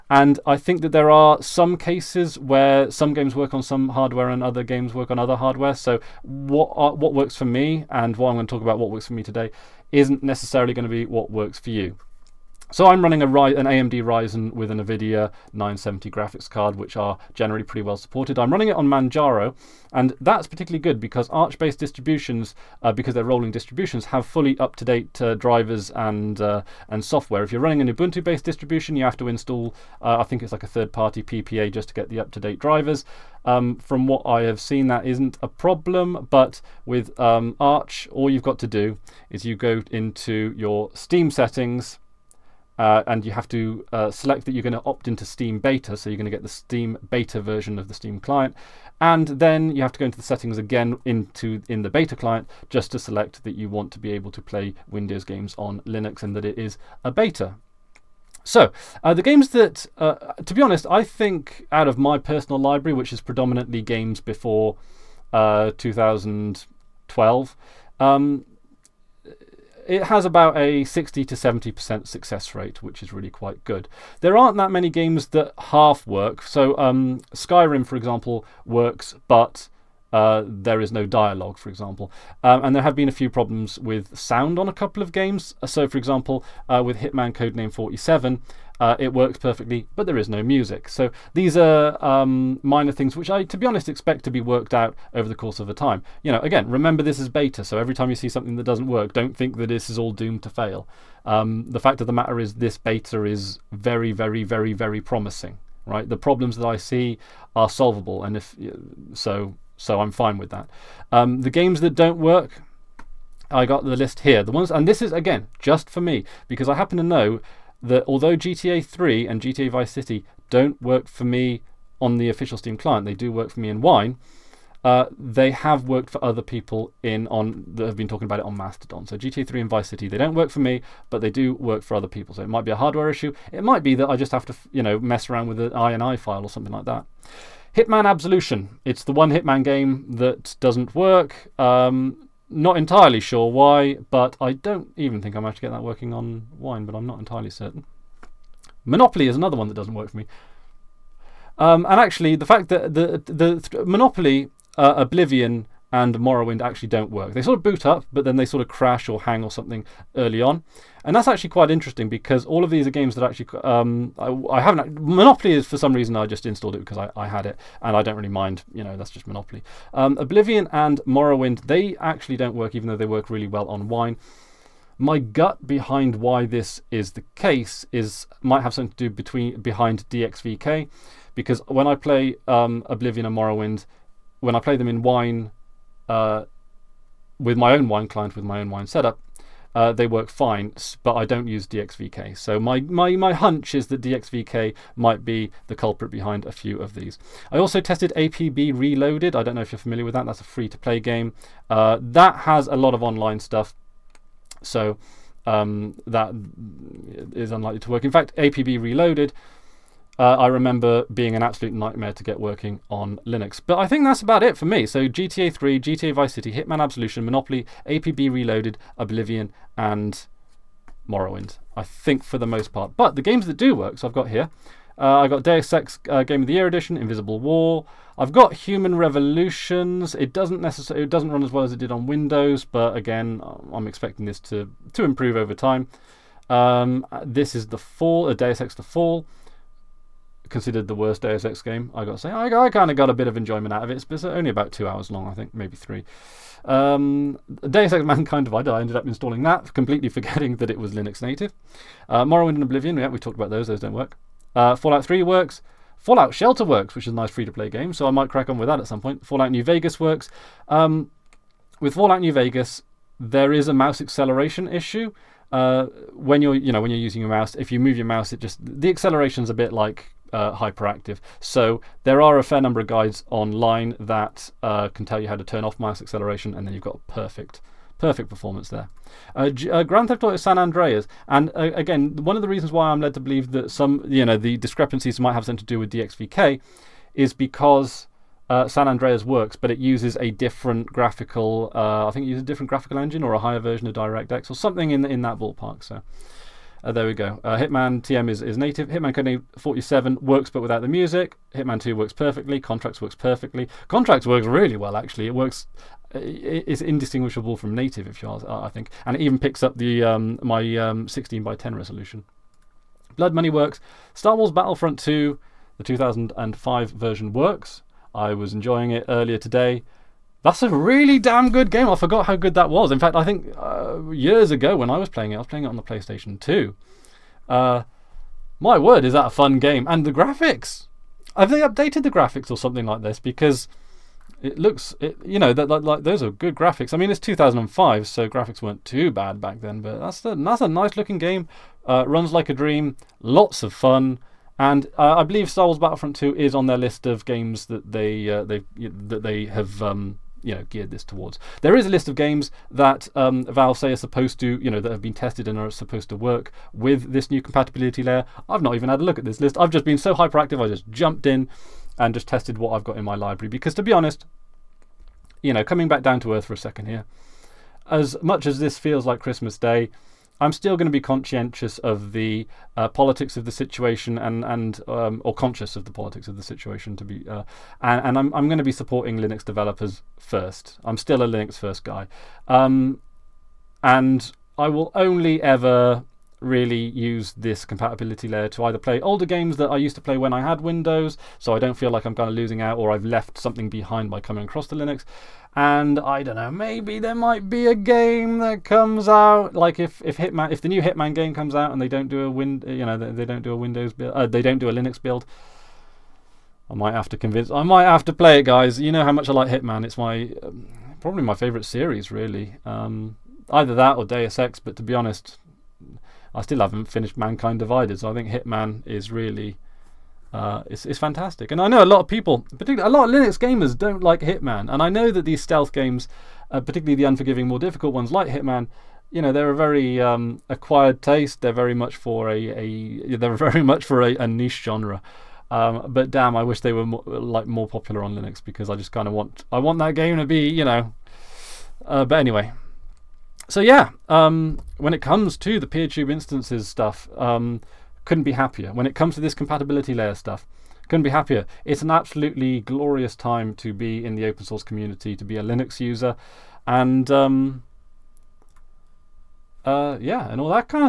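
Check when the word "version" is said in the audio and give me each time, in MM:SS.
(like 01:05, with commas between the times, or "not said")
00:47, 04:53, 05:16.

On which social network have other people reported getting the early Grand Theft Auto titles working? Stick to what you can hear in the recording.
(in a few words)
Mastodon.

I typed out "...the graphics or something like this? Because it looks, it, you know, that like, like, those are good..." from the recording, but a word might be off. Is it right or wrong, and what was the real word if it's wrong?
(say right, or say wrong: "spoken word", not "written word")
right.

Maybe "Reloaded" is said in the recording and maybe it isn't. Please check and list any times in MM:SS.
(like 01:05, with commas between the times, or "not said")
03:18, 03:28, 03:38.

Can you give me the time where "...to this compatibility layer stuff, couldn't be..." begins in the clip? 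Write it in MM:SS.
07:29.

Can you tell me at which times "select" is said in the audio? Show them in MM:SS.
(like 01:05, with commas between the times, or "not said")
00:44, 00:52.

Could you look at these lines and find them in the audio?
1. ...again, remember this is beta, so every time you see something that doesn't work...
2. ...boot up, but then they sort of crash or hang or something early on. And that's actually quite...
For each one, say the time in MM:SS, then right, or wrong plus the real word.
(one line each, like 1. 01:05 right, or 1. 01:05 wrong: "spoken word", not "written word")
1. 01:36 right
2. 02:37 right.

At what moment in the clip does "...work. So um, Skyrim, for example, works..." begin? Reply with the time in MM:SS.
01:16.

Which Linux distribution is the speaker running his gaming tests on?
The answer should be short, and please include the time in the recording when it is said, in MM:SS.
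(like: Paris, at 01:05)
Manjaro, at 00:18.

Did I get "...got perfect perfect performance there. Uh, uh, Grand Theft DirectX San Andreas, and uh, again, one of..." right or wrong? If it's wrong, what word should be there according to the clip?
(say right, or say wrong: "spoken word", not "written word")
wrong: "Auto", not "DirectX".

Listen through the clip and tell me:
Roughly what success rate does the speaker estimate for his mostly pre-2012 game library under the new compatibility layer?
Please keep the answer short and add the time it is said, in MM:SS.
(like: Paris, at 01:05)
60 to 70%, at 01:10.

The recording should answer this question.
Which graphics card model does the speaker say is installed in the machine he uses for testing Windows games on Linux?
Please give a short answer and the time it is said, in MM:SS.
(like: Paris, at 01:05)
NVIDIA 970, at 00:14.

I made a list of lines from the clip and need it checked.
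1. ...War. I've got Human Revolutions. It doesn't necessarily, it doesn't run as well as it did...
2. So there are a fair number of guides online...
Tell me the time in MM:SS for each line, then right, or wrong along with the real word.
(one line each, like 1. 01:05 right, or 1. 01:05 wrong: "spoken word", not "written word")
1. 03:47 right
2. 04:31 right.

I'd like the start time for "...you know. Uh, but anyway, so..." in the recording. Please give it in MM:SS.
07:20.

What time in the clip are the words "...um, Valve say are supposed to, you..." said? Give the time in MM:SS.
05:53.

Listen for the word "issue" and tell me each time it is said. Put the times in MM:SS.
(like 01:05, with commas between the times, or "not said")
02:13, 04:24.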